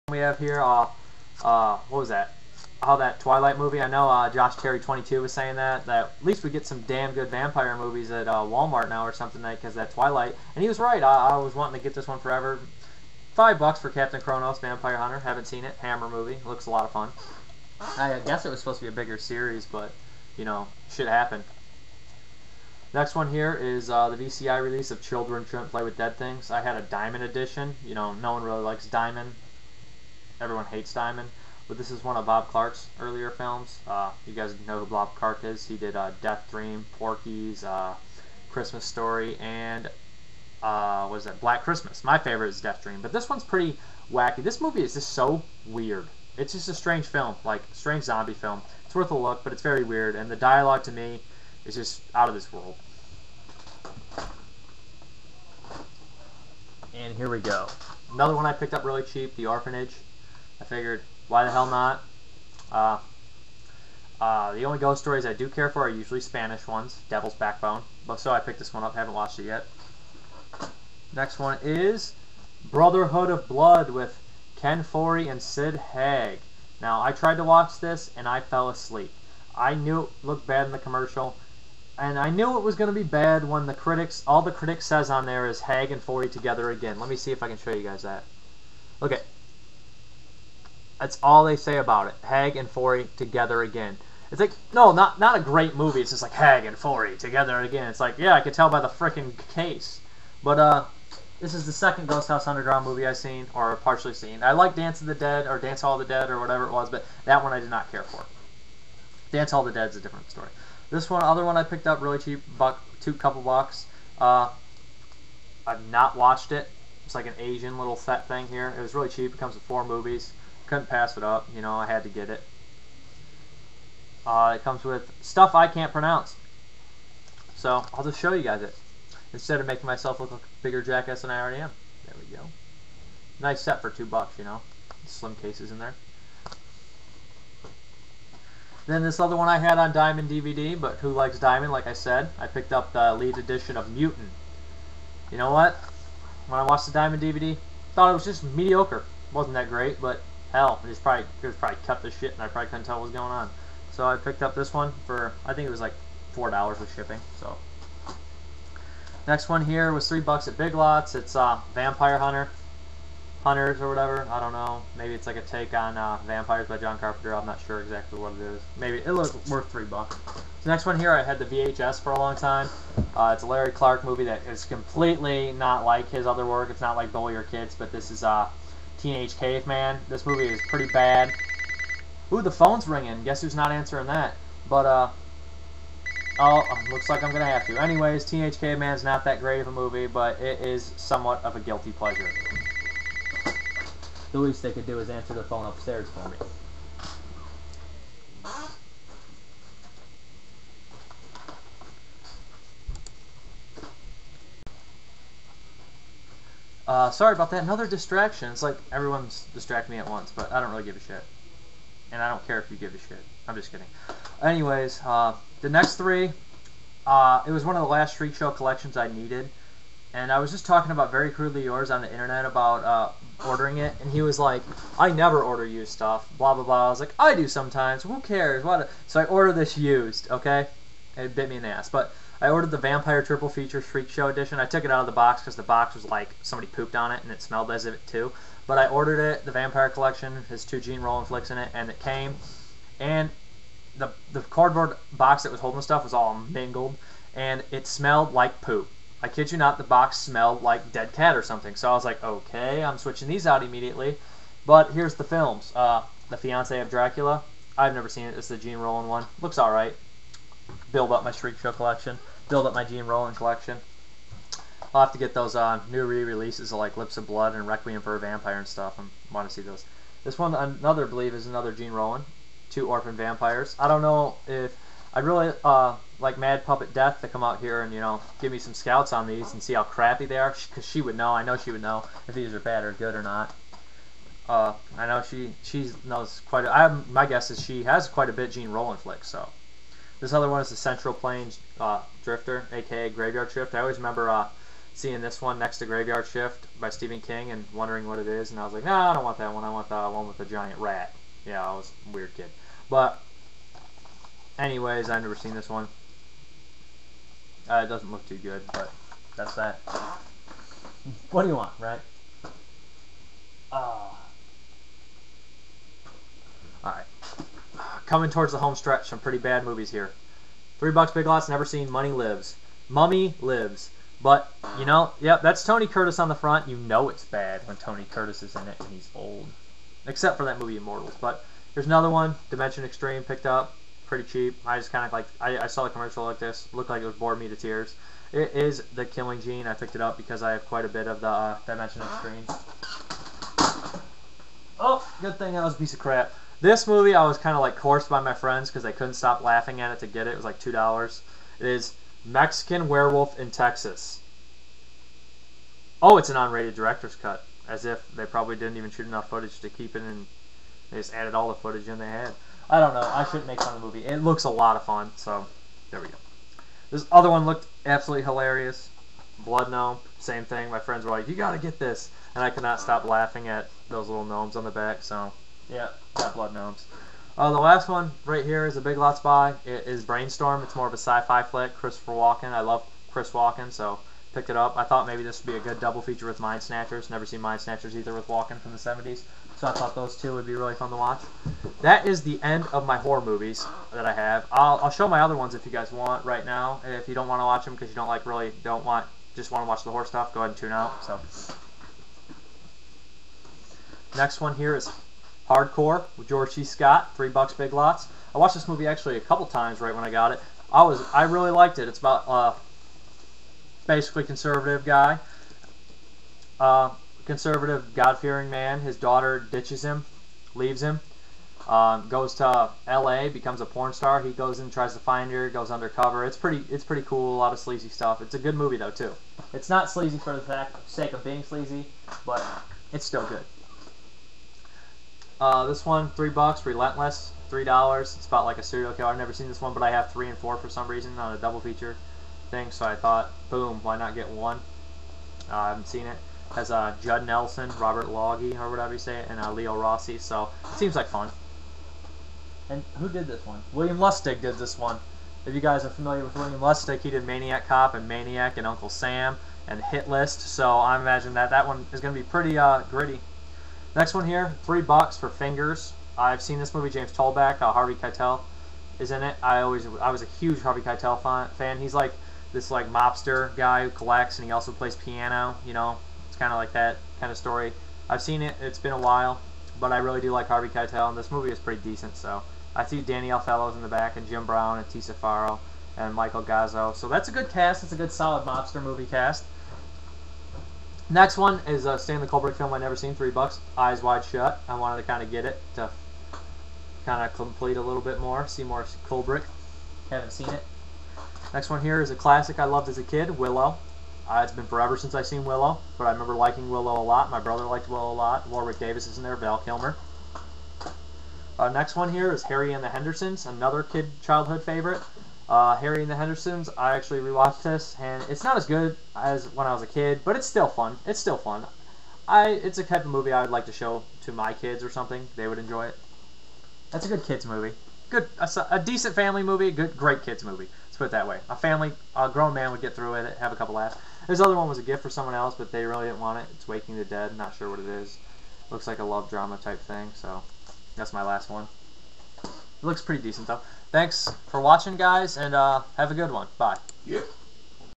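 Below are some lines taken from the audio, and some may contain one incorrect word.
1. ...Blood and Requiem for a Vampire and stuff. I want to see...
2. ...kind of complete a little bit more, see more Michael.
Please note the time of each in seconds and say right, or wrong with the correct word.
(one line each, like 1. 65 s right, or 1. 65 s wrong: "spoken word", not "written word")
1. 267 s right
2. 497 s wrong: "Kubrick", not "Michael".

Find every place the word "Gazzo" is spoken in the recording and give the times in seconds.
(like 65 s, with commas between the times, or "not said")
486 s.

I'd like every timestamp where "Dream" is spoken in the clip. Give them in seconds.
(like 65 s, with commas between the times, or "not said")
36 s, 42 s.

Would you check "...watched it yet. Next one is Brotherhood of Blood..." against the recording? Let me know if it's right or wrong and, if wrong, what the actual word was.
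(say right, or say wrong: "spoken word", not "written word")
right.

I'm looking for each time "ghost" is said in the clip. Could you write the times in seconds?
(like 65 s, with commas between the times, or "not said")
64 s, 102 s.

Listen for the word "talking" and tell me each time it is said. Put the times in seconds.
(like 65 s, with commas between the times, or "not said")
220 s.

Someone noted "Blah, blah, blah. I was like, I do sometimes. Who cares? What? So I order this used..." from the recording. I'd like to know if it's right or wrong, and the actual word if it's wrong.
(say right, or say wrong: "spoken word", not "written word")
right.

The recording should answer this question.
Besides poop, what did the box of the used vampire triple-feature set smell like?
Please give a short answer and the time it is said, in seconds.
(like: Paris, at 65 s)
dead cat, at 250 s.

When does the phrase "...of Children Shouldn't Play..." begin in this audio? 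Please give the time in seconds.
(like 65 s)
24 s.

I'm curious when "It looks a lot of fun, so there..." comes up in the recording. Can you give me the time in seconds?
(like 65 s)
364 s.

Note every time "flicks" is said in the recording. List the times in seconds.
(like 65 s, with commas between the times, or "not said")
241 s, 288 s, 381 s.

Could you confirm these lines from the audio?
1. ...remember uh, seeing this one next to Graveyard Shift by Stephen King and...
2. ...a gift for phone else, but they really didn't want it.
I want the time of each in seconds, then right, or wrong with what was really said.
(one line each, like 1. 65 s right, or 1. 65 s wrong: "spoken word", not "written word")
1. 293 s right
2. 534 s wrong: "someone", not "phone".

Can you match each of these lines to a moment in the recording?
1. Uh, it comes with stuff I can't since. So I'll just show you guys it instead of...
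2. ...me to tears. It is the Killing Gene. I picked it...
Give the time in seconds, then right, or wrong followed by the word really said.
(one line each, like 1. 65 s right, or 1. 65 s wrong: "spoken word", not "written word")
1. 124 s wrong: "pronounce", not "since"
2. 337 s right.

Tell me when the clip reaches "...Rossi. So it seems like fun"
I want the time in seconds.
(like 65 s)
449 s.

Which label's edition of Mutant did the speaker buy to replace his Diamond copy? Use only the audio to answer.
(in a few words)
Elite.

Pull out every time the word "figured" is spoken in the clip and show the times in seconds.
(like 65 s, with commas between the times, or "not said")
60 s.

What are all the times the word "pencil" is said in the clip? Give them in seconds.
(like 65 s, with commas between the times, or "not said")
not said.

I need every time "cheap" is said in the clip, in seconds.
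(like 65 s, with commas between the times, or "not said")
59 s, 112 s, 119 s, 334 s.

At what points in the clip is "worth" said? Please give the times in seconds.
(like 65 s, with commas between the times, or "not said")
48 s, 169 s.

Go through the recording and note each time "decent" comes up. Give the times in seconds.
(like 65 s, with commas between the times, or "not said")
481 s, 528 s, 543 s.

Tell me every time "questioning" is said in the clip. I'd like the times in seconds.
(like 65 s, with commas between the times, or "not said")
not said.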